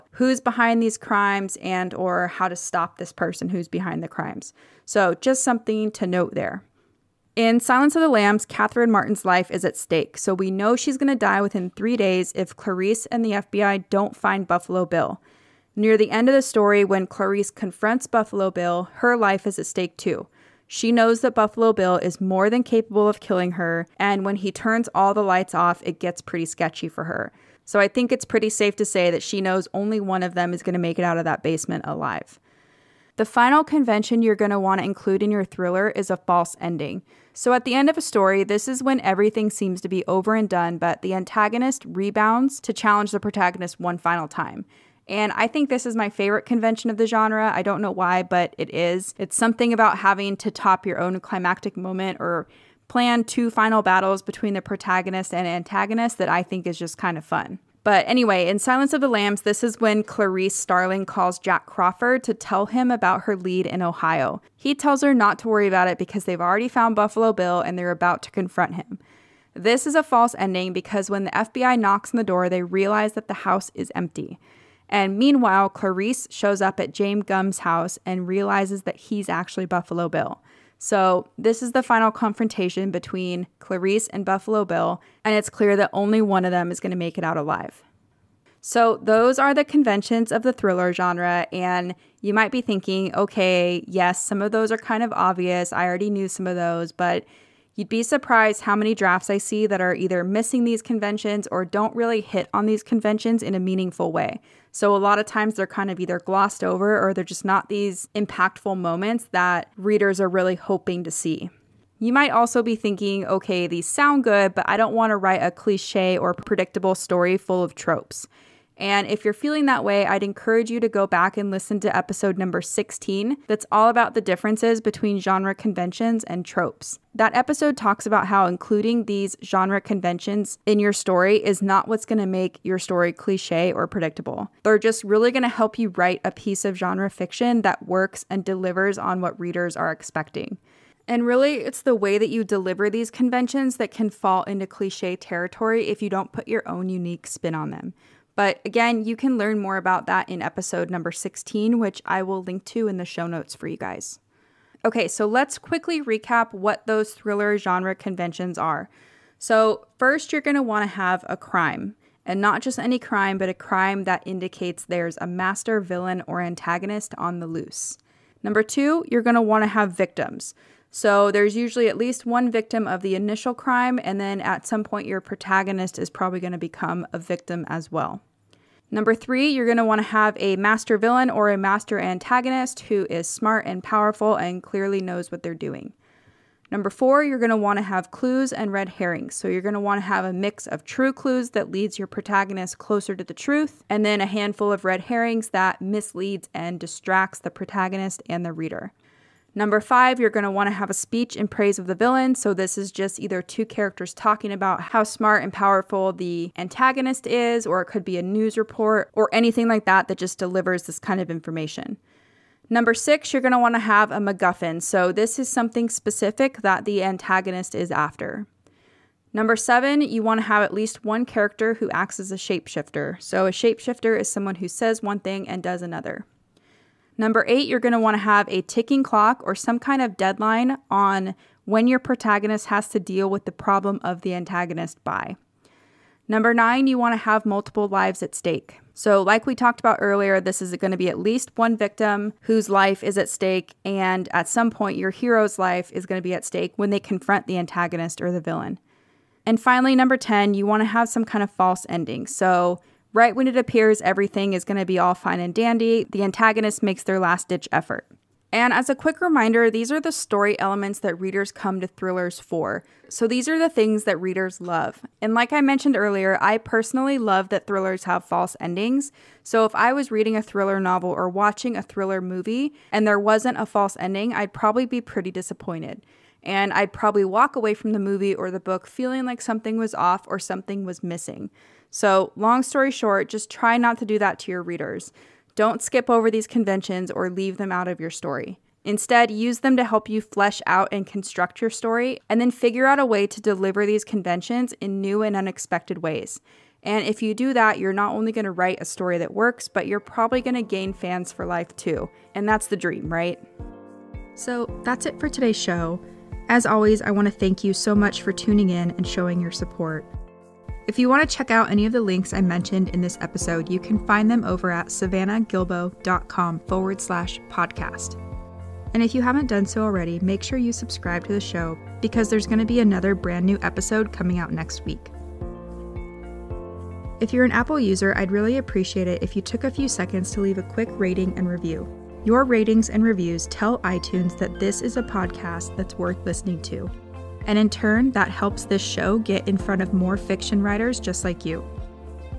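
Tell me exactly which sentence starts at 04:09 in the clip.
And finally, number 10, you want to have some kind of false ending.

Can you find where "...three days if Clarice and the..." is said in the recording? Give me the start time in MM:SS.
00:11.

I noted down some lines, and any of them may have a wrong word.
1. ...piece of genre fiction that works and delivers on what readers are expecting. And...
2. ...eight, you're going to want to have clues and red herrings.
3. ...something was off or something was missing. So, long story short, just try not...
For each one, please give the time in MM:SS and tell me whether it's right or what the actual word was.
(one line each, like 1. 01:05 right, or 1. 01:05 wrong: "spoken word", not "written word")
1. 02:16 right
2. 03:06 wrong: "four", not "eight"
3. 04:39 right.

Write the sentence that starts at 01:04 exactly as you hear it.
He tells her not to worry about it because they've already found Buffalo Bill and they're about to confront him.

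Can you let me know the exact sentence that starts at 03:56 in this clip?
Number nine, you want to have multiple lives at stake.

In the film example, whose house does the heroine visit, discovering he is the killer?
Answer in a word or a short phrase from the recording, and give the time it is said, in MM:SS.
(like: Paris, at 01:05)
James Gumb, at 01:16.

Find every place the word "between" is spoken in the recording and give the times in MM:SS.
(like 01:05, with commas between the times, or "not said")
00:54, 01:22, 02:04.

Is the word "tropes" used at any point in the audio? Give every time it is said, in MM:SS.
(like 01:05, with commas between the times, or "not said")
01:57, 02:06.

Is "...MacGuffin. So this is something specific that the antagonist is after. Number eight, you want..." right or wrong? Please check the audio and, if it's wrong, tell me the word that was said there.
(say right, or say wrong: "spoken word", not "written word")
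wrong: "seven", not "eight".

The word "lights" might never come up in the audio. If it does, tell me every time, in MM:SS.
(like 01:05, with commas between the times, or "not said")
00:25.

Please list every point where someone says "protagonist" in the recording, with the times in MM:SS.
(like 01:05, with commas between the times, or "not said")
00:43, 00:54, 02:55, 03:12, 03:17, 03:51.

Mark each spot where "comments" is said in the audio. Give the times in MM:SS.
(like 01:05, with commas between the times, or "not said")
not said.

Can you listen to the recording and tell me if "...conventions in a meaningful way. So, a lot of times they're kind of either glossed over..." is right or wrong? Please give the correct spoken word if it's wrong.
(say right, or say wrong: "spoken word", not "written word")
right.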